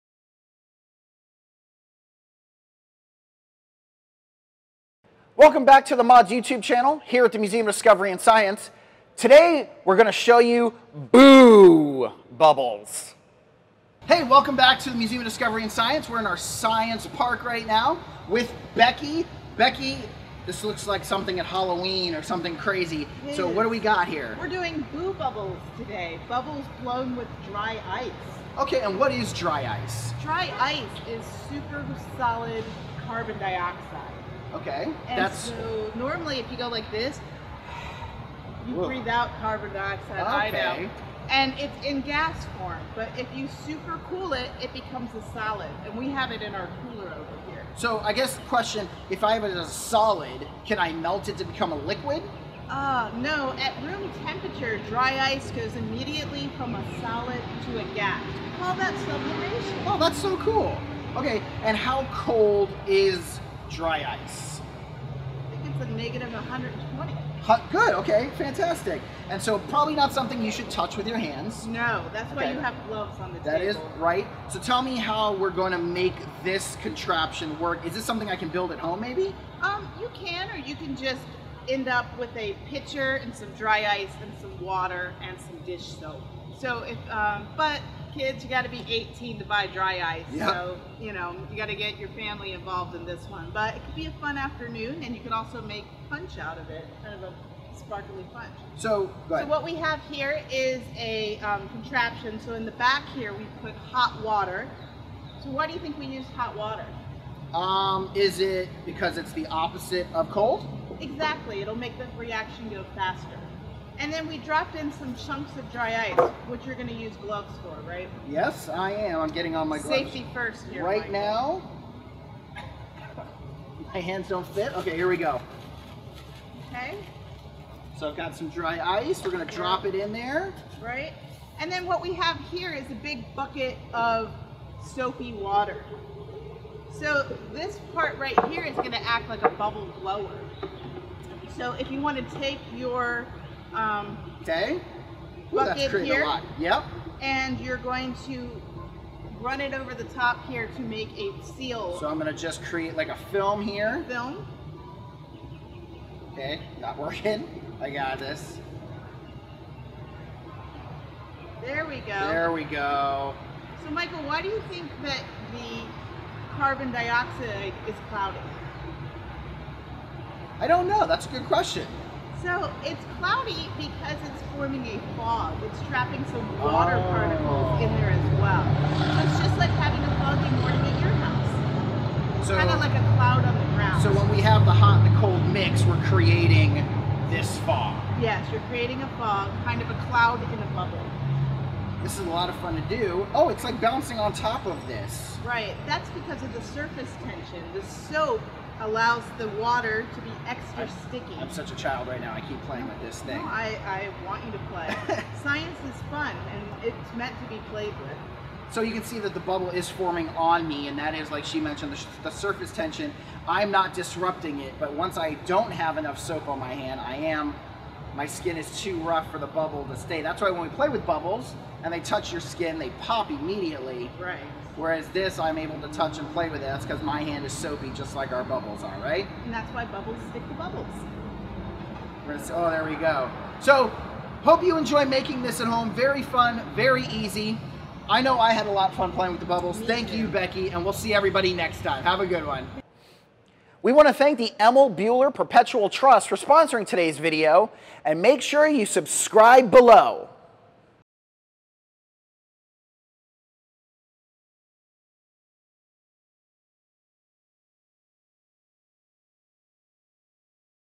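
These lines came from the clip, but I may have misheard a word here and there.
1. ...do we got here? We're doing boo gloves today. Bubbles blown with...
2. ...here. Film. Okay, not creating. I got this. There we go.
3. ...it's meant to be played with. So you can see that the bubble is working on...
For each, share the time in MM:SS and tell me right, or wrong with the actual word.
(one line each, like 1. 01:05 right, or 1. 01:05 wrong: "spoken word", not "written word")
1. 00:23 wrong: "bubbles", not "gloves"
2. 02:33 wrong: "working", not "creating"
3. 03:26 wrong: "forming", not "working".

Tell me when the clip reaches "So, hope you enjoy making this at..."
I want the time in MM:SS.
03:53.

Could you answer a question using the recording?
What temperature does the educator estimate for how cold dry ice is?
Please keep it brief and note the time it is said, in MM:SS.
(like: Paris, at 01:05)
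-120, at 01:05.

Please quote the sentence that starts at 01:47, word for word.
Um, is it because it's the opposite of cold?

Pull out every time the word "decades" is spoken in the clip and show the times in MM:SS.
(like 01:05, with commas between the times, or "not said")
not said.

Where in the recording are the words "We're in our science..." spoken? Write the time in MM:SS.
00:16.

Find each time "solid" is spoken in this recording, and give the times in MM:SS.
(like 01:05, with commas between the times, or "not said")
00:32, 00:45, 00:49, 00:57.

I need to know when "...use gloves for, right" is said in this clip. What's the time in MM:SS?
01:56.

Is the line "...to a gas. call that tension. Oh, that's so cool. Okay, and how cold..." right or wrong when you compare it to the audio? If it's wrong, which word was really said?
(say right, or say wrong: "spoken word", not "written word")
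wrong: "sublimation", not "tension".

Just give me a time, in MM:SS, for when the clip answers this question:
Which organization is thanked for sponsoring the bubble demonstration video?
04:04.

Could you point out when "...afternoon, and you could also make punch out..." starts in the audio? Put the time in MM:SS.
01:34.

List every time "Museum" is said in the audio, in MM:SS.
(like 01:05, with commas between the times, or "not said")
00:07, 00:14.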